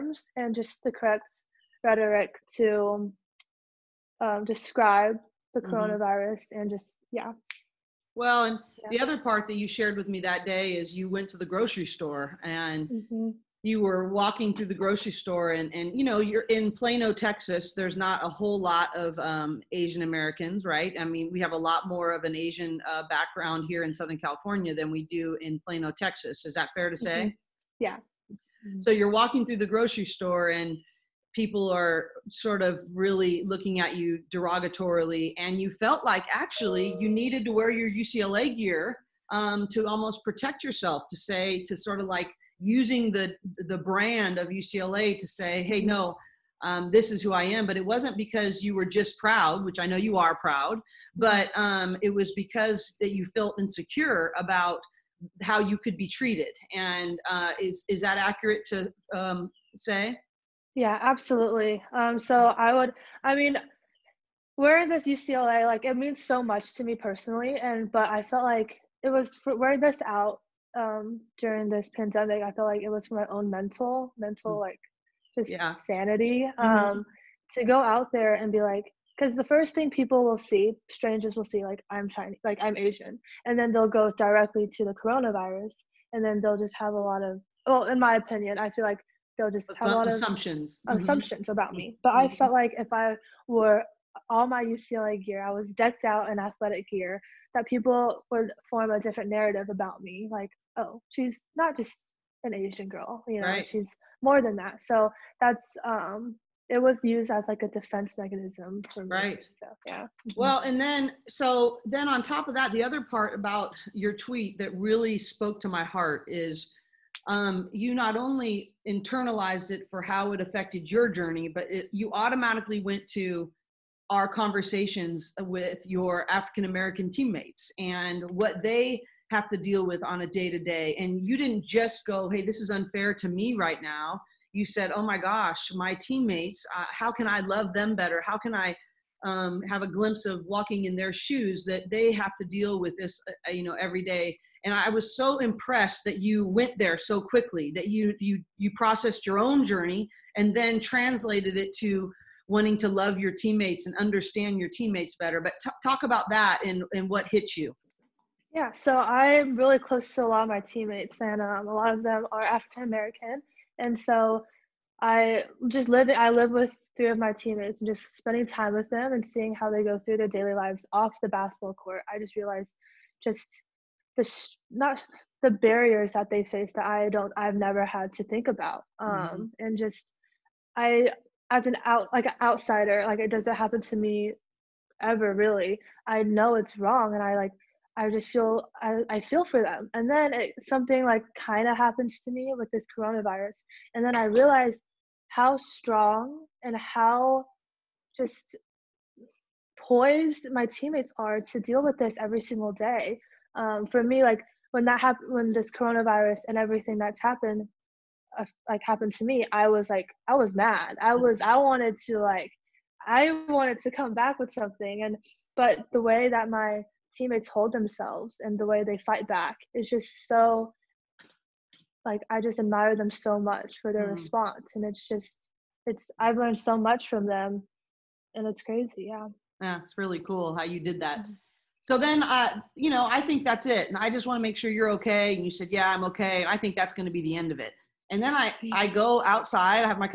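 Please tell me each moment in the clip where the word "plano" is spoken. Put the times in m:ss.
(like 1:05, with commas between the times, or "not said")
0:16, 0:25.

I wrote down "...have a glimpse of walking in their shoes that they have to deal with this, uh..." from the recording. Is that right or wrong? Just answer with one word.
right.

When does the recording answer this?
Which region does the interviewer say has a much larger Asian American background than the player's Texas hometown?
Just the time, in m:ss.
0:23.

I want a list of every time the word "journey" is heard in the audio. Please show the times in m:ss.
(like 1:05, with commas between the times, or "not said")
2:01, 2:29.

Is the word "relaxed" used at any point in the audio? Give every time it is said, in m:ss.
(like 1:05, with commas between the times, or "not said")
not said.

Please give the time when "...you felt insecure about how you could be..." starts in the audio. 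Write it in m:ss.
0:53.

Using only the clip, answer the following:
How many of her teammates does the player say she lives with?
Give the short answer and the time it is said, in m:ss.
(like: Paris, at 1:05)
3, at 2:46.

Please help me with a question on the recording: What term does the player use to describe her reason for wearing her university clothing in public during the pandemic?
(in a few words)
defense mechanism.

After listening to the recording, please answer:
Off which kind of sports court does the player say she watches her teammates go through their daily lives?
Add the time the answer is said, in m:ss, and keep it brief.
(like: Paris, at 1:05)
basketball court, at 2:51.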